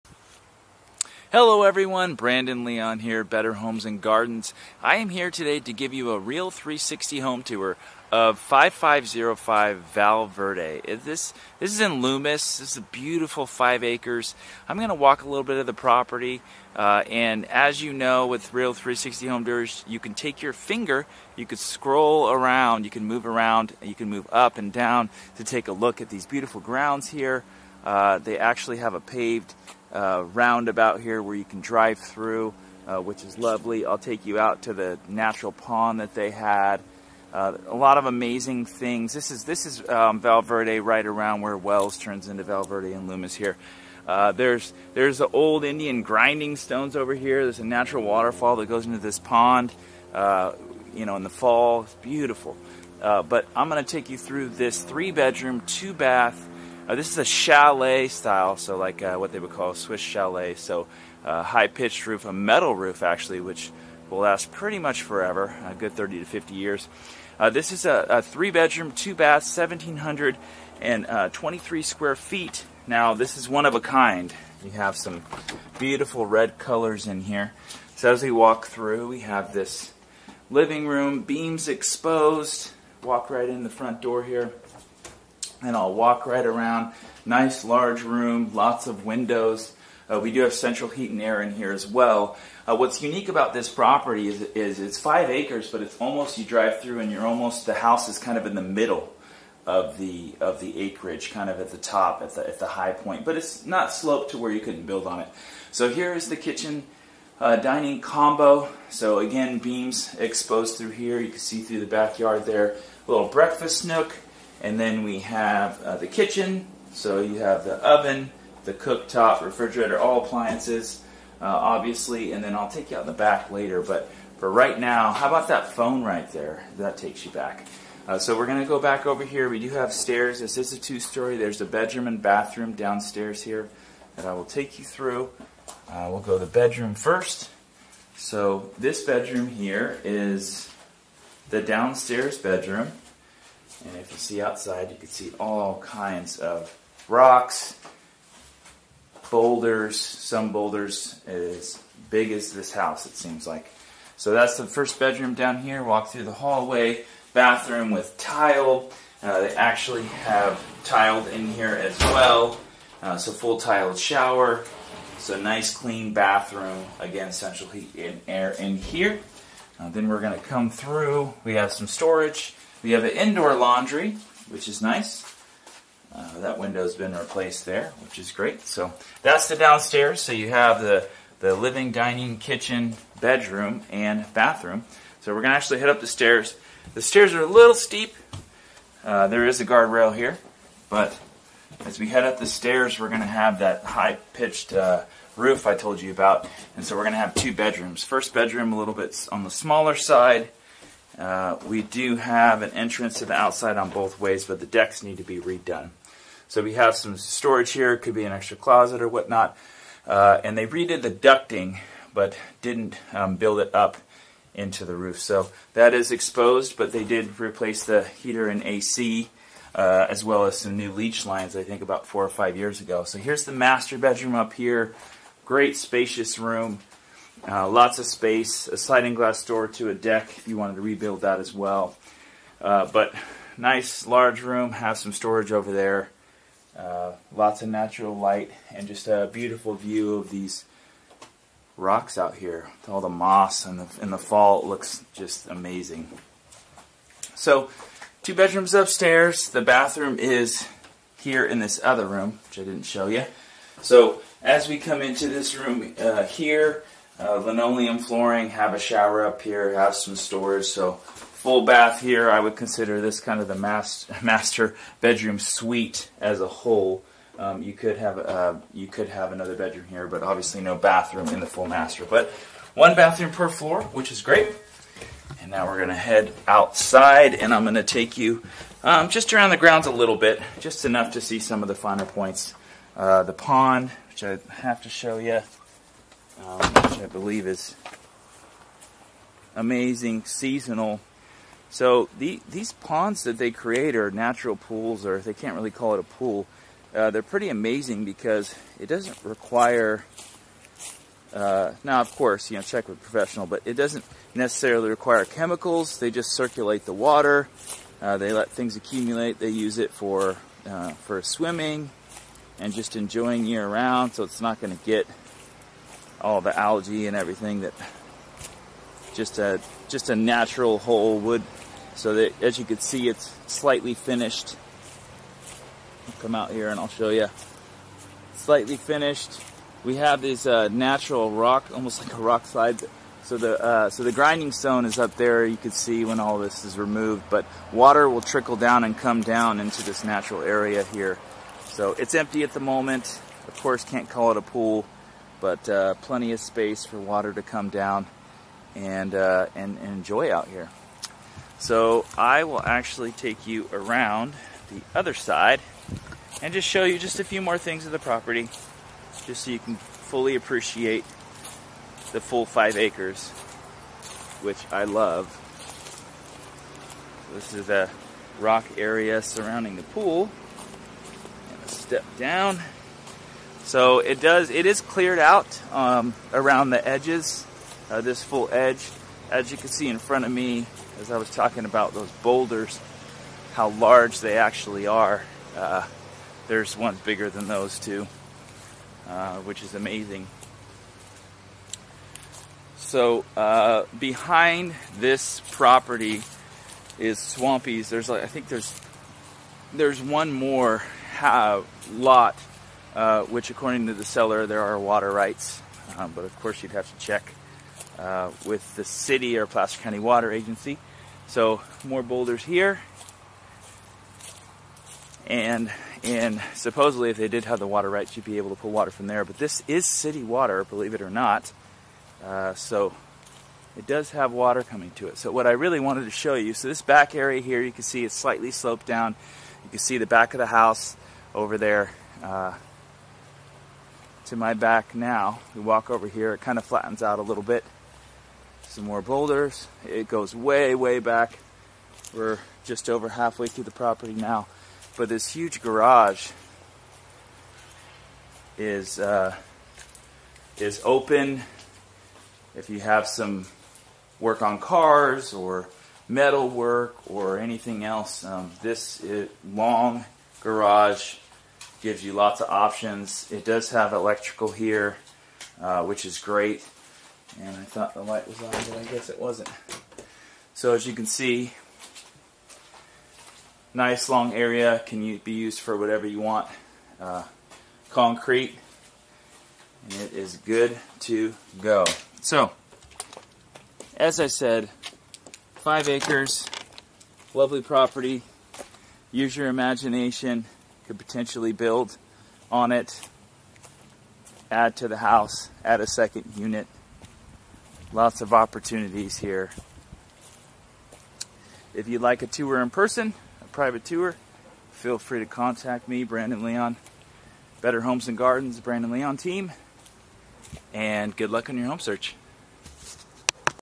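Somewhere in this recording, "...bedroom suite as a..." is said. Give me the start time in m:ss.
4:24.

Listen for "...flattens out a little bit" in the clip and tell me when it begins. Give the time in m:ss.
7:16.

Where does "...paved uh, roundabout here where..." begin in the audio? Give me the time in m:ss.
0:28.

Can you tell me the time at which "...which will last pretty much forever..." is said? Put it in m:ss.
1:03.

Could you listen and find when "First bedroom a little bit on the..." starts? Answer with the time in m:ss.
3:18.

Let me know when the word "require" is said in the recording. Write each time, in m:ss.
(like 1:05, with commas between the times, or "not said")
4:59, 5:04.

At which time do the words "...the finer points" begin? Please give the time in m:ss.
4:41.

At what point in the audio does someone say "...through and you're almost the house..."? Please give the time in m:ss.
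1:36.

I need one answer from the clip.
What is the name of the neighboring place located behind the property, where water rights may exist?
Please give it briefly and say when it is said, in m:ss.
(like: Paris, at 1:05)
Swampy's, at 6:37.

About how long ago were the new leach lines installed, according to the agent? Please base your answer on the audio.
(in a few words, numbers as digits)
4 or 5 years.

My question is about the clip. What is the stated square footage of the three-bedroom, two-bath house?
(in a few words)
1,723.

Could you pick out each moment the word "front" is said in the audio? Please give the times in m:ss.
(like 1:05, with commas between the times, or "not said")
1:23, 6:19.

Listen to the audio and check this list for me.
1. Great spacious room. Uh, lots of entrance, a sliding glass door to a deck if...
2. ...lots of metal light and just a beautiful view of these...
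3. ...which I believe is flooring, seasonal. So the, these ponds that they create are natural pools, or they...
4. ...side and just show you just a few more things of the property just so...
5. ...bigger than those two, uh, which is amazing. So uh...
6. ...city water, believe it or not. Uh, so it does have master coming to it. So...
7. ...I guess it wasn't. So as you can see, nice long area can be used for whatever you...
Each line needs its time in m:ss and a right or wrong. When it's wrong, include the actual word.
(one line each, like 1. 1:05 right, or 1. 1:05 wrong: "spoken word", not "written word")
1. 3:45 wrong: "space", not "entrance"
2. 3:57 wrong: "natural", not "metal"
3. 4:46 wrong: "amazing", not "flooring"
4. 5:55 right
5. 6:27 right
6. 6:59 wrong: "water", not "master"
7. 7:48 right.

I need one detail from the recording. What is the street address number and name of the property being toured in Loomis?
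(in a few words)
5505 Val Verde.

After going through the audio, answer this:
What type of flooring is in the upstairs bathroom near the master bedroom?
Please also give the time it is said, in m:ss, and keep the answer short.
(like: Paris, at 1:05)
Linoleum, at 4:17.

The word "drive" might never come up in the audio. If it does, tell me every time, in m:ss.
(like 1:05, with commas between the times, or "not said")
0:31, 1:36.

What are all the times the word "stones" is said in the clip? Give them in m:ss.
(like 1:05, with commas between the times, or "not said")
0:46, 5:34.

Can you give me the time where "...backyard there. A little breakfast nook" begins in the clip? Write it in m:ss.
1:51.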